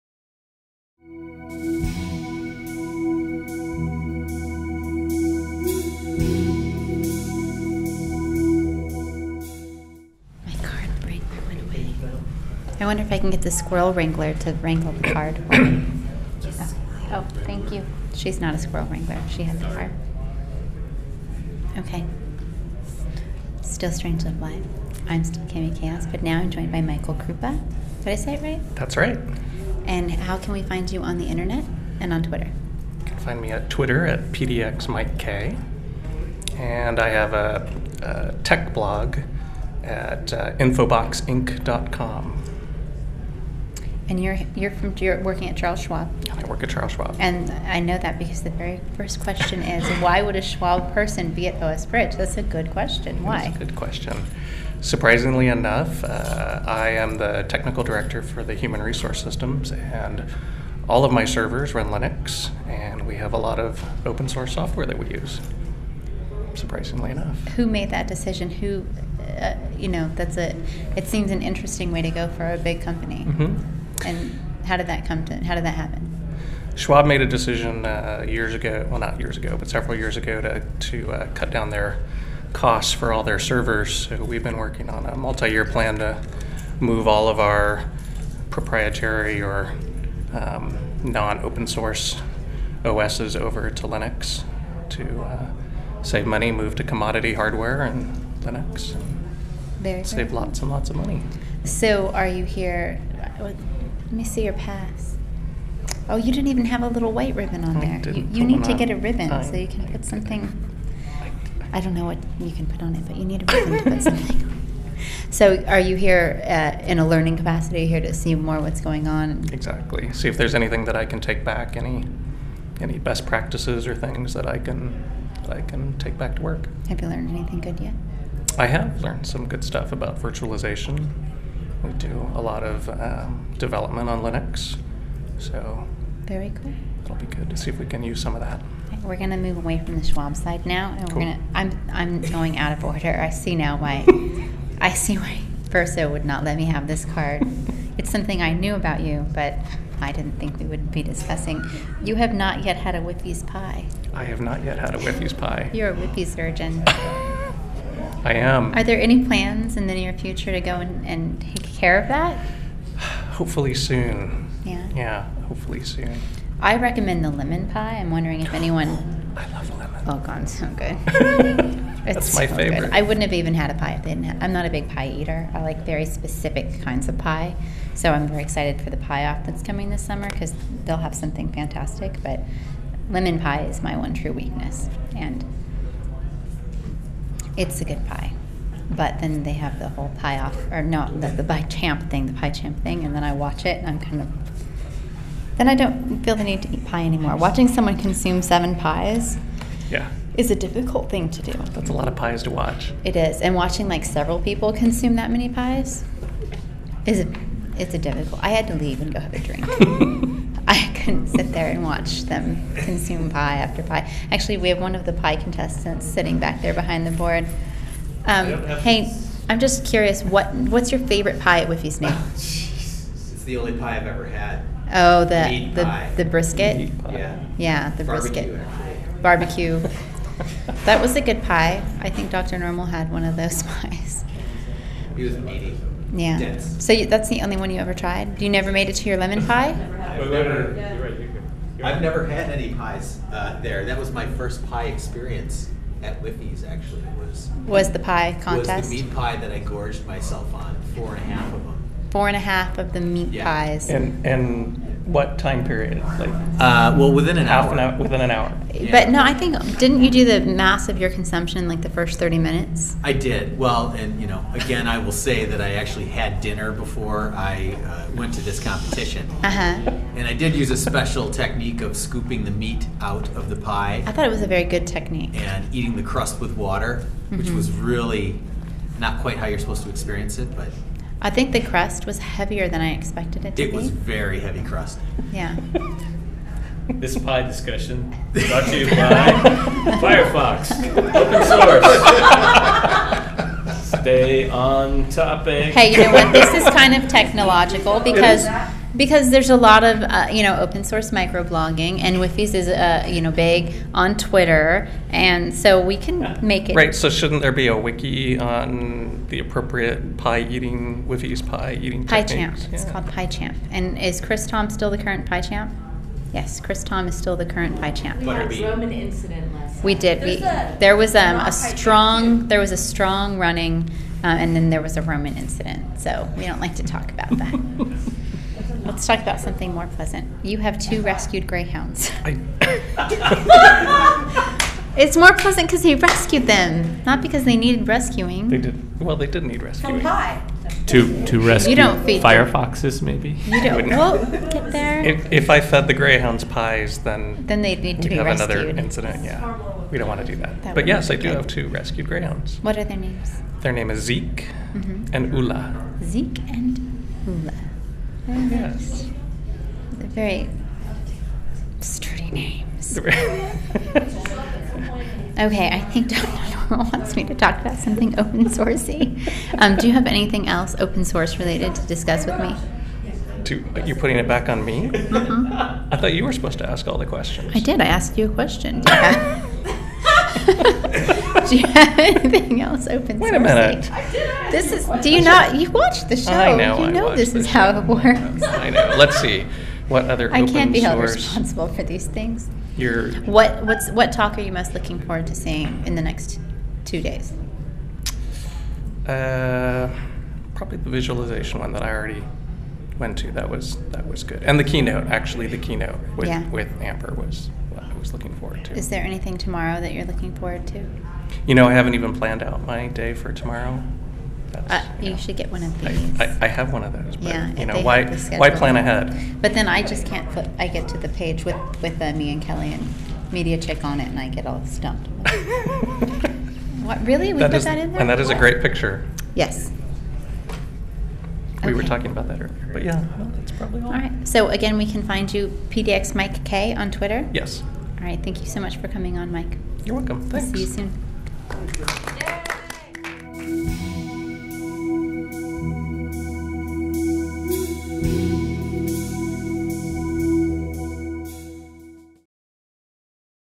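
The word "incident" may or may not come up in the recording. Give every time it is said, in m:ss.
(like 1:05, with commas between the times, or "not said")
5:18, 5:25, 5:48.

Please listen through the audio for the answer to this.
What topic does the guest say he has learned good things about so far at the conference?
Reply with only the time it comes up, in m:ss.
2:10.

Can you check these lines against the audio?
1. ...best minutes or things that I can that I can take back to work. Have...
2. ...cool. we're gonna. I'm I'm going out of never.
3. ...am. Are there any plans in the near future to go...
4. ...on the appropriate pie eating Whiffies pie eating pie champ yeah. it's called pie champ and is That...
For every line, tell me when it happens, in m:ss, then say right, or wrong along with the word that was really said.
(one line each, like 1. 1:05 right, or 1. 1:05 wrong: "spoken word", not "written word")
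1. 2:02 wrong: "practices", not "minutes"
2. 2:21 wrong: "order", not "never"
3. 2:38 right
4. 5:08 wrong: "Chris", not "That".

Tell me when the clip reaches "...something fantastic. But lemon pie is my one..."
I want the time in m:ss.
3:01.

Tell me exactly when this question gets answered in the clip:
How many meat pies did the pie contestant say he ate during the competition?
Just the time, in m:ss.
4:10.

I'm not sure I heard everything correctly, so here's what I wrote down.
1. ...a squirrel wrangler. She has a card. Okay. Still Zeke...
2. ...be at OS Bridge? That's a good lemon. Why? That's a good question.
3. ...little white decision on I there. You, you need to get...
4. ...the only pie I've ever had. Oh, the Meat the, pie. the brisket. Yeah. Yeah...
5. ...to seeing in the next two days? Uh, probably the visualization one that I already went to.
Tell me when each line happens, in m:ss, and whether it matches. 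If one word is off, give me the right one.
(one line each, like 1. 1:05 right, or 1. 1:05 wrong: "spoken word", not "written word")
1. 0:18 wrong: "Strange", not "Zeke"
2. 0:51 wrong: "question", not "lemon"
3. 1:46 wrong: "ribbon", not "decision"
4. 3:43 right
5. 6:35 right.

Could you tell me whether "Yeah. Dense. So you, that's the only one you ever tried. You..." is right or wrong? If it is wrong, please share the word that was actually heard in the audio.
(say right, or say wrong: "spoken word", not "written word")
right.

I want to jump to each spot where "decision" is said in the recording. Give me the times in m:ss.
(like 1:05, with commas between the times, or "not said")
1:08, 1:17.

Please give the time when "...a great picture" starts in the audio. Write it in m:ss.
7:08.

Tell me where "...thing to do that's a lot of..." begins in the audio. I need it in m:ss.
3:21.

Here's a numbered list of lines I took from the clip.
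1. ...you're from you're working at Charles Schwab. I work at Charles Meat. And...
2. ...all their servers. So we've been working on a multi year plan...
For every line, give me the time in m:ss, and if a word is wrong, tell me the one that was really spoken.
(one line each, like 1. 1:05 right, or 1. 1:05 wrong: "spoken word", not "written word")
1. 0:44 wrong: "Schwab", not "Meat"
2. 1:23 right.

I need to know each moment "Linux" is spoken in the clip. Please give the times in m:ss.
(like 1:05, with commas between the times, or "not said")
1:01, 1:33, 1:38, 2:14.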